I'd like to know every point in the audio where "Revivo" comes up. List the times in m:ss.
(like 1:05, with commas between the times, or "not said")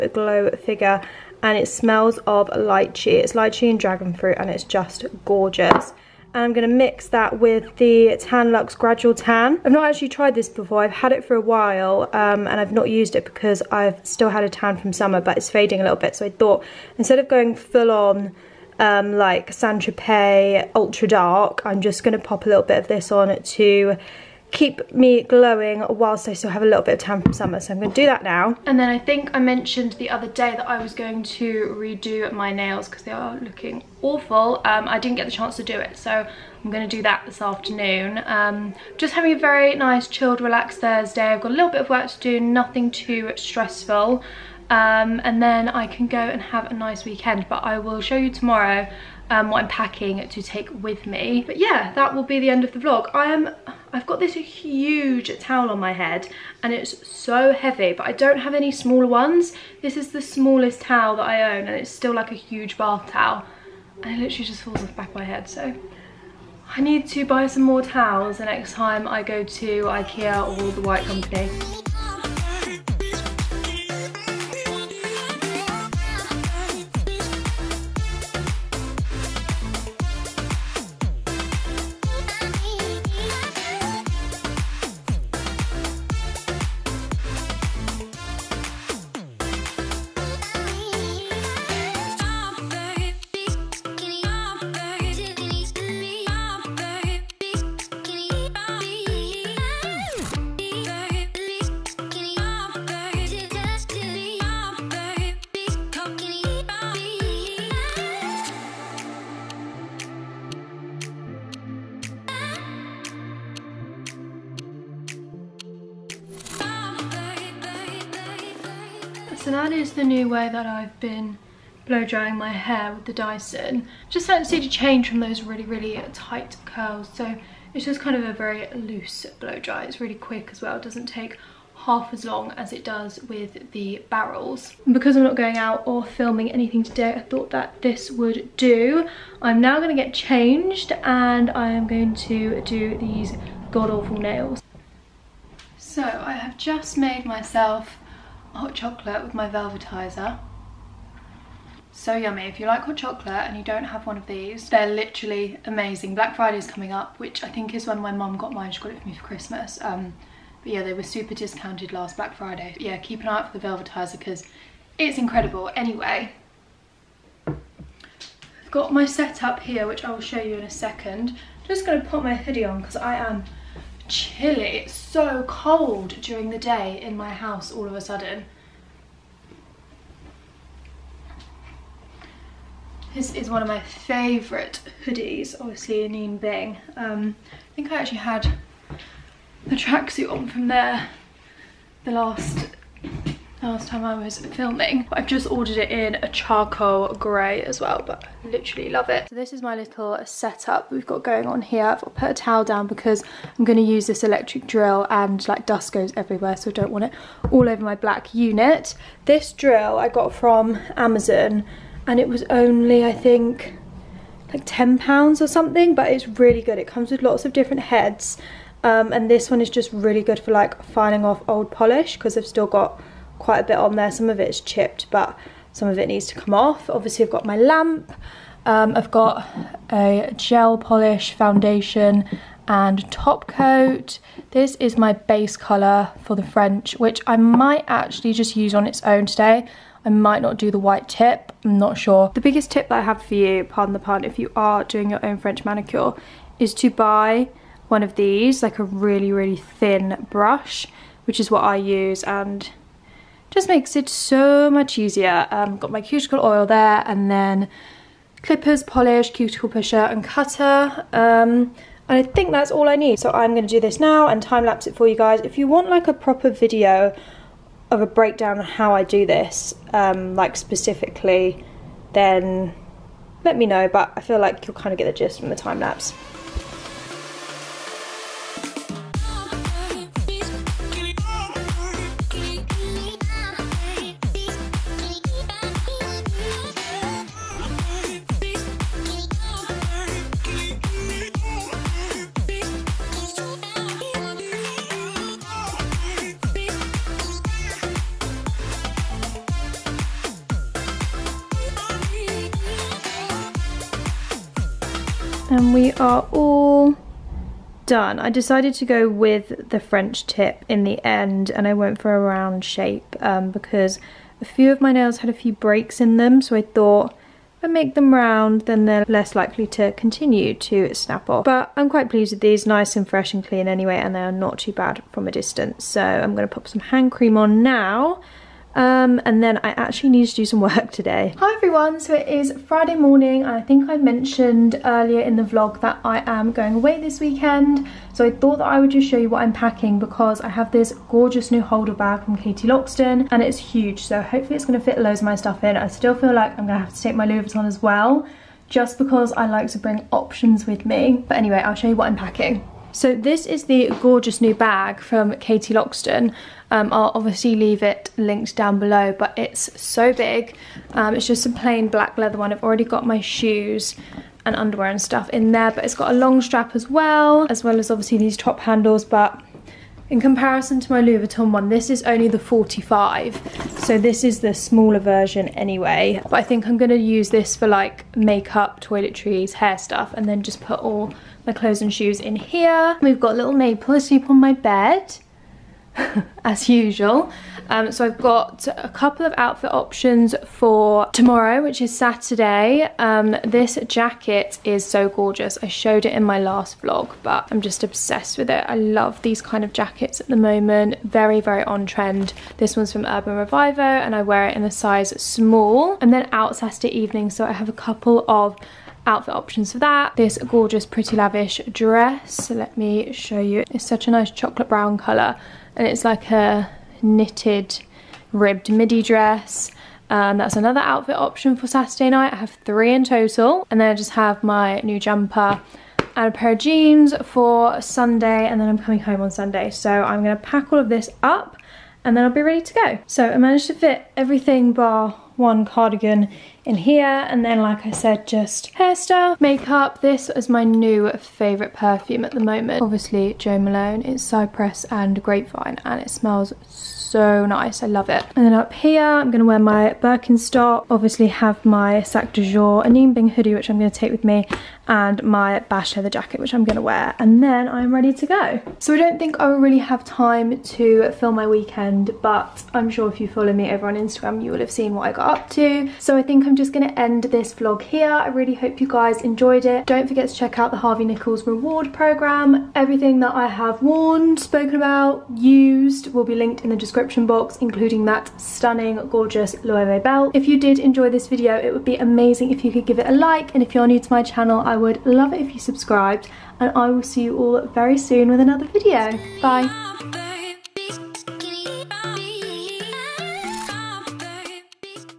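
6:43.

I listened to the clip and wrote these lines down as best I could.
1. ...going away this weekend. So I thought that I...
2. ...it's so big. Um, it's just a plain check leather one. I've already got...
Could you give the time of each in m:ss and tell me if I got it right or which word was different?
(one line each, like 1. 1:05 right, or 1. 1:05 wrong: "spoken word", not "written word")
1. 5:36 right
2. 5:59 wrong: "black", not "check".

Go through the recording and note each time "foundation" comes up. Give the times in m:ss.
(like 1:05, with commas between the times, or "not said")
3:51.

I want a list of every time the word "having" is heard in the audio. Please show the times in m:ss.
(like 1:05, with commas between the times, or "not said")
0:39.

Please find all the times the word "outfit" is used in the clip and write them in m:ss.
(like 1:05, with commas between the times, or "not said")
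6:29, 6:49, 7:00.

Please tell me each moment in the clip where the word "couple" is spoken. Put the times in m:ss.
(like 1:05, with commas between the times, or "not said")
6:28, 6:47.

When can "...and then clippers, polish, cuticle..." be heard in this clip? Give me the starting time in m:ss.
4:17.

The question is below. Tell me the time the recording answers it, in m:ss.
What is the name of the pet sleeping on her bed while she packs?
6:23.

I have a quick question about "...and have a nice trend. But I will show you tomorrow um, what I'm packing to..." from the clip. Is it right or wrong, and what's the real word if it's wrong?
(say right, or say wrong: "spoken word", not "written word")
wrong: "weekend", not "trend".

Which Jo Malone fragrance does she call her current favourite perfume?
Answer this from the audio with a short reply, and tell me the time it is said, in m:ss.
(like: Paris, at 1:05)
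Cypress and Grapevine, at 7:24.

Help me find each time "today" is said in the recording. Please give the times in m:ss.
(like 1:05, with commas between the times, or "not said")
2:16, 3:59, 5:30.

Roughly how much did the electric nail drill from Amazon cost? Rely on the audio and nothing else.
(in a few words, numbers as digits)
10 pounds.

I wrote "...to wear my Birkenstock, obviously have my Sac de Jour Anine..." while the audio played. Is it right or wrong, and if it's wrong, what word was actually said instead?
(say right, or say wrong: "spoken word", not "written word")
right.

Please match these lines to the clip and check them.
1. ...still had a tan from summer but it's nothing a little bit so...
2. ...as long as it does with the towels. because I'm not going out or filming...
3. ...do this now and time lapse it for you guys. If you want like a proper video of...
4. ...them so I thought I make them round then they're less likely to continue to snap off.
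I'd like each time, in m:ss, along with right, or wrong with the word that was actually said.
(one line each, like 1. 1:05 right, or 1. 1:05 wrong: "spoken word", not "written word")
1. 0:14 wrong: "fading", not "nothing"
2. 2:12 wrong: "barrels", not "towels"
3. 4:23 right
4. 5:16 right.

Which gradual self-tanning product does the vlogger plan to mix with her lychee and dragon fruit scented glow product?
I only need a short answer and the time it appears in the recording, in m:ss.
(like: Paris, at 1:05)
Tan Luxe Gradual Tan, at 0:08.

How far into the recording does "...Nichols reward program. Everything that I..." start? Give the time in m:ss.
7:51.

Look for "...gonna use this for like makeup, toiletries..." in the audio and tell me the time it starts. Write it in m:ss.
6:16.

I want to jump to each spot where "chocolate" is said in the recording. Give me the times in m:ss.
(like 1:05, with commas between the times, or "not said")
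2:28, 2:32, 6:54.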